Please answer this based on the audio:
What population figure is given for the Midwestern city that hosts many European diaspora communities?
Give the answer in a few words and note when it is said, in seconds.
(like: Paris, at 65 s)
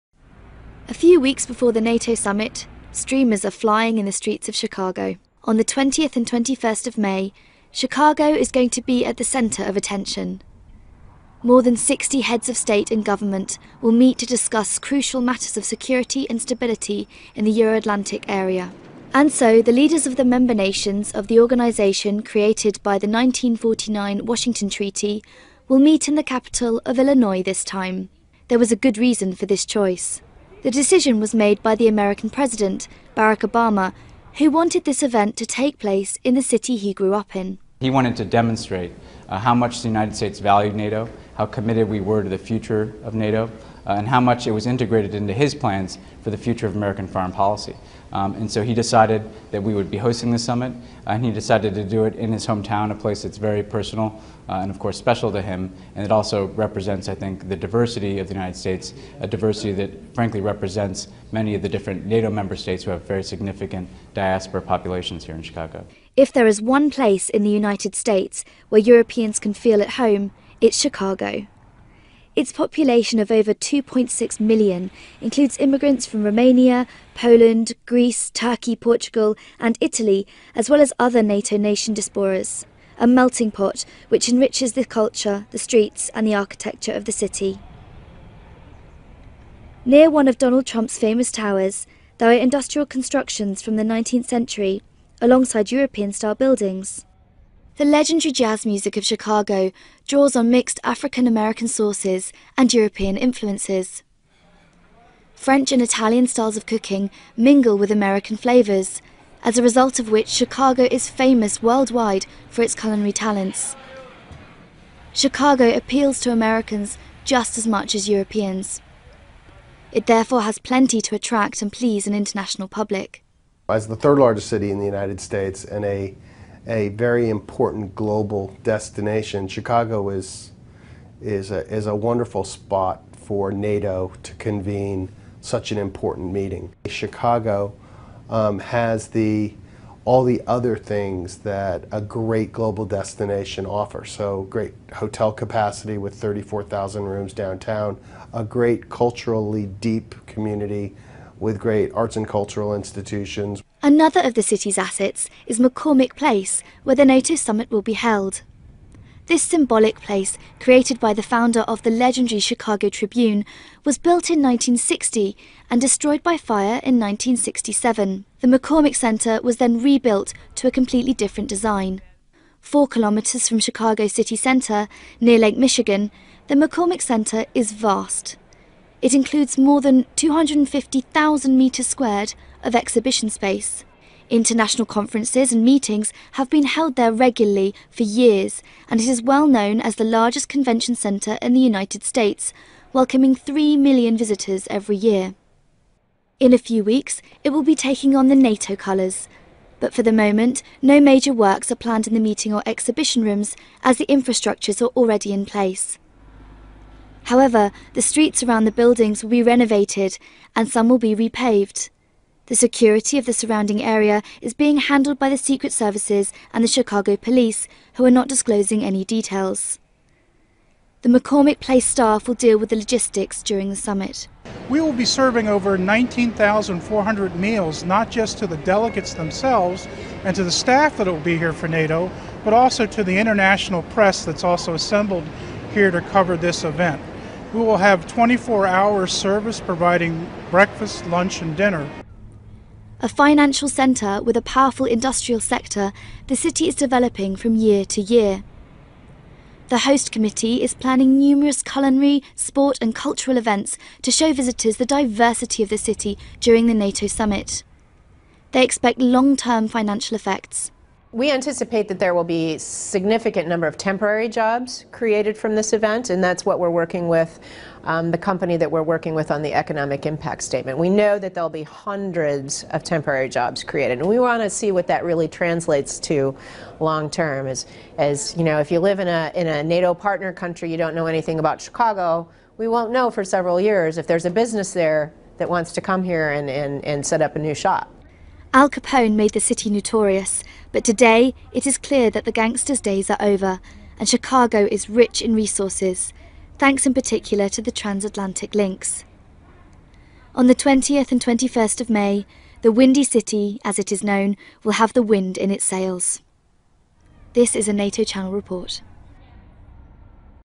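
over 2.6 million, at 73 s.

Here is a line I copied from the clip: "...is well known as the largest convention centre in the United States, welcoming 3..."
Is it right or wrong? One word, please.
right.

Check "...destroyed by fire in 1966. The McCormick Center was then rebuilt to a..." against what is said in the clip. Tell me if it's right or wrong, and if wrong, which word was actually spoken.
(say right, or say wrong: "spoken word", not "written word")
wrong: "1967", not "1966".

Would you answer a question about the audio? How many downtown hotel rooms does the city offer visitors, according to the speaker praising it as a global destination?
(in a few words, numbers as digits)
34,000.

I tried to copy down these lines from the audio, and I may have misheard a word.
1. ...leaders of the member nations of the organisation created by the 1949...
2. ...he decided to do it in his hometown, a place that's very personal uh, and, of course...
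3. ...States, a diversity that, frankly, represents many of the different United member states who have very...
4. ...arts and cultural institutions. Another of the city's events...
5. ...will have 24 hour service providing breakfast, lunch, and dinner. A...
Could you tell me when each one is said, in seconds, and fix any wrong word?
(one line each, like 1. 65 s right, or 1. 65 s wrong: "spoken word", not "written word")
1. 19 s right
2. 51 s right
3. 58 s wrong: "NATO", not "United"
4. 151 s wrong: "assets", not "events"
5. 237 s right.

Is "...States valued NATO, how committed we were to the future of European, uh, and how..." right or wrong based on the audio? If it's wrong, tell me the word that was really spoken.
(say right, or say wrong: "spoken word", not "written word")
wrong: "NATO", not "European".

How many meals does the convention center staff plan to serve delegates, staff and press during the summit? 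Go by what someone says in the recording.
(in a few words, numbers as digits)
19,400.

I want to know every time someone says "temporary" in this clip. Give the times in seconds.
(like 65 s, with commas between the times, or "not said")
263 s, 272 s.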